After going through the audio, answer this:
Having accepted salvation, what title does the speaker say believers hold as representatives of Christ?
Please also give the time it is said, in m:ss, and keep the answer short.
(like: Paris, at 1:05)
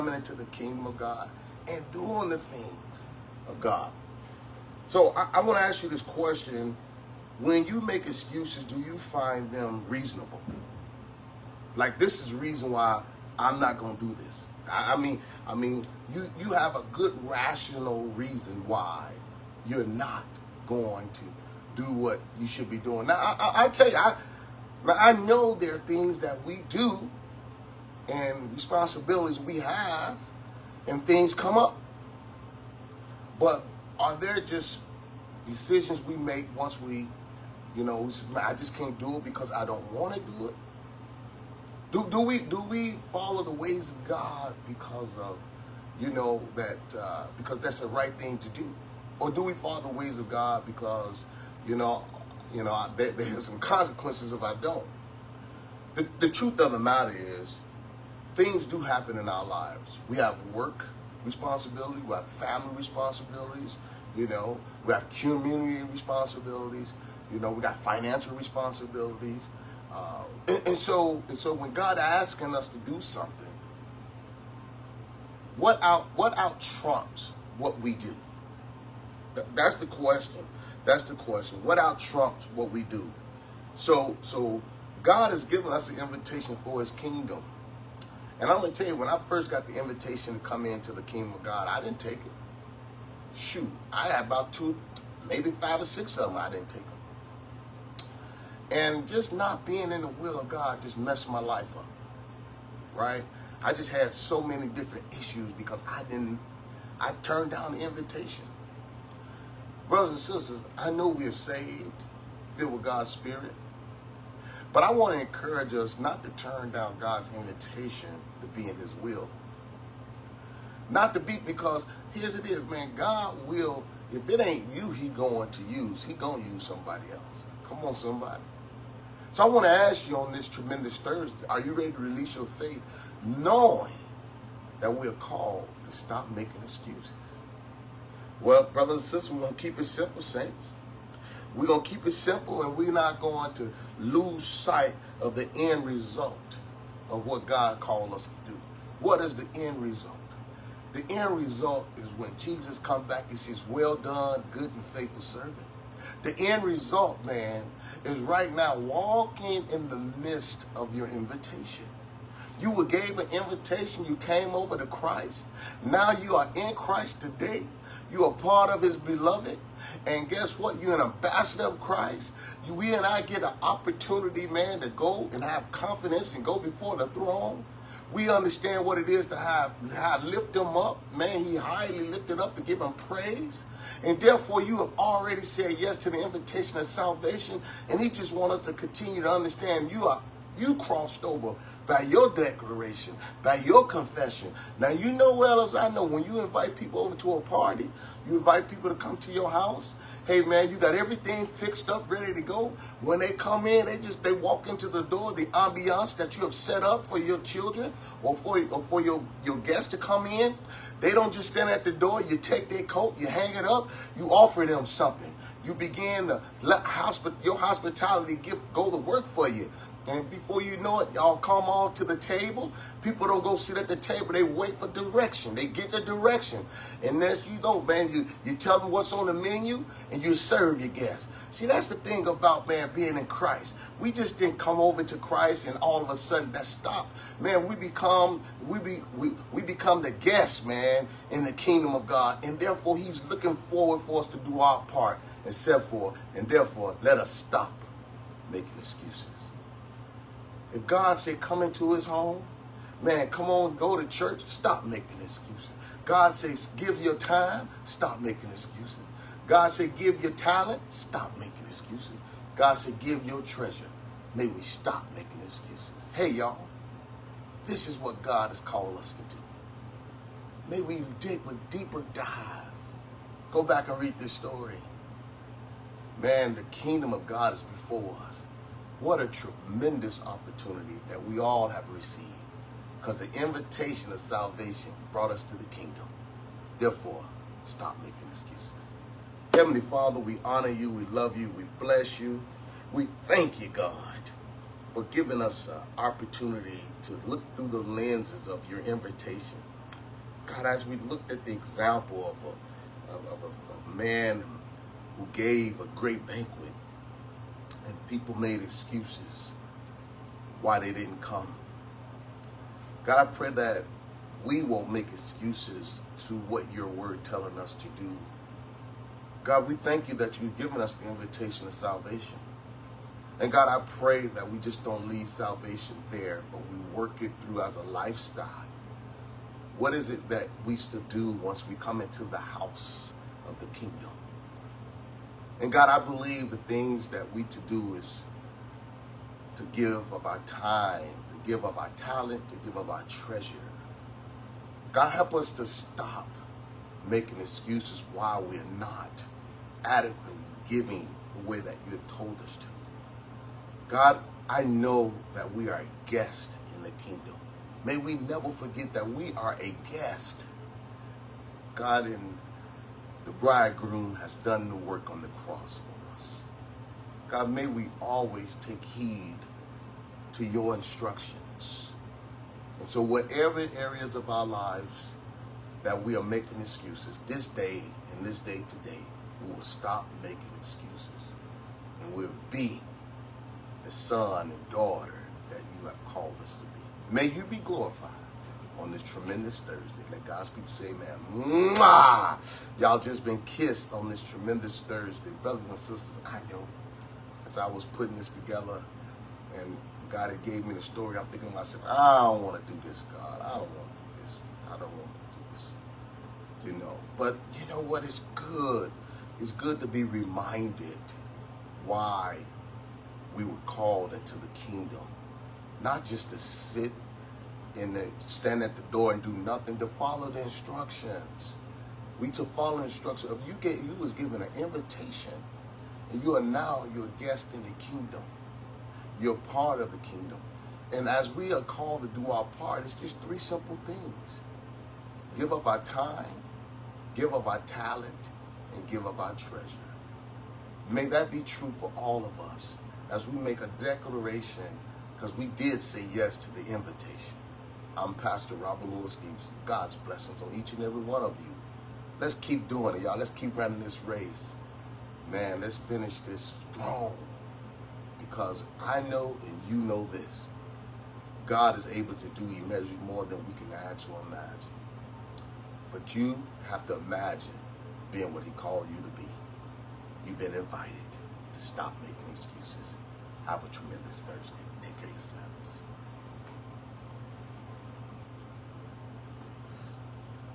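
Ambassador of Christ, at 2:51.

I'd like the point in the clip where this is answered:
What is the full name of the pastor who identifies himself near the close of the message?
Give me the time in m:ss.
7:28.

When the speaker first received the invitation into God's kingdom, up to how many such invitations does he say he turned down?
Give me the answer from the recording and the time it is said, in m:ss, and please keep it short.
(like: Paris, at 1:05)
6, at 1:35.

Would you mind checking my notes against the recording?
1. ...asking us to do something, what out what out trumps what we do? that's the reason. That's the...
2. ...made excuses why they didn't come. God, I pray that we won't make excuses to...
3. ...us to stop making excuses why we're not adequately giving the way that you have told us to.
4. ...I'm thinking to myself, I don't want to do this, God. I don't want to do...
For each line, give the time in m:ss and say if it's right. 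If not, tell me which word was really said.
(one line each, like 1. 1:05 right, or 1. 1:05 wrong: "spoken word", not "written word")
1. 1:11 wrong: "question", not "reason"
2. 5:08 right
3. 5:45 right
4. 6:41 right.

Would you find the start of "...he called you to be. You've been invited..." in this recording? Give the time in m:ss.
7:48.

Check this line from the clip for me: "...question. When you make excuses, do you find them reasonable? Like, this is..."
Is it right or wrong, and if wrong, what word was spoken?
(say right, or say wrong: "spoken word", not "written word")
right.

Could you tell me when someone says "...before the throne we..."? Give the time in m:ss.
2:56.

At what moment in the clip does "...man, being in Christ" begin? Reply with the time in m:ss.
3:52.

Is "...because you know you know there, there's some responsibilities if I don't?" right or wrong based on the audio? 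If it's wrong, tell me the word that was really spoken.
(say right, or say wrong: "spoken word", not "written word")
wrong: "consequences", not "responsibilities".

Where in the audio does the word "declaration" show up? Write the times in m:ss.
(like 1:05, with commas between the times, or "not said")
3:12, 7:23.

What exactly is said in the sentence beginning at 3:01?
Man, he highly lifted up to give him praise.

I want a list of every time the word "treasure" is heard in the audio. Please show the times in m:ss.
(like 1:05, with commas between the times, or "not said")
4:23, 5:43, 7:19.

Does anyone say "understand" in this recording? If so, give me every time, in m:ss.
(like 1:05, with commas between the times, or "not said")
2:58, 3:09.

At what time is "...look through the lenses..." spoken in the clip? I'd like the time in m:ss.
4:57.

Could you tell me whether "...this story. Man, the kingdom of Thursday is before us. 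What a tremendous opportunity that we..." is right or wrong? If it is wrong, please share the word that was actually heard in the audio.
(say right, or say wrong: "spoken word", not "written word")
wrong: "God", not "Thursday".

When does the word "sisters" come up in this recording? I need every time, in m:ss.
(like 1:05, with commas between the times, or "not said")
1:50, 2:19, 6:35.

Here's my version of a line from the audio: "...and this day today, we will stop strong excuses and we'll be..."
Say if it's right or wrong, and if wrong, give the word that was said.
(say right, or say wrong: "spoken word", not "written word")
wrong: "making", not "strong".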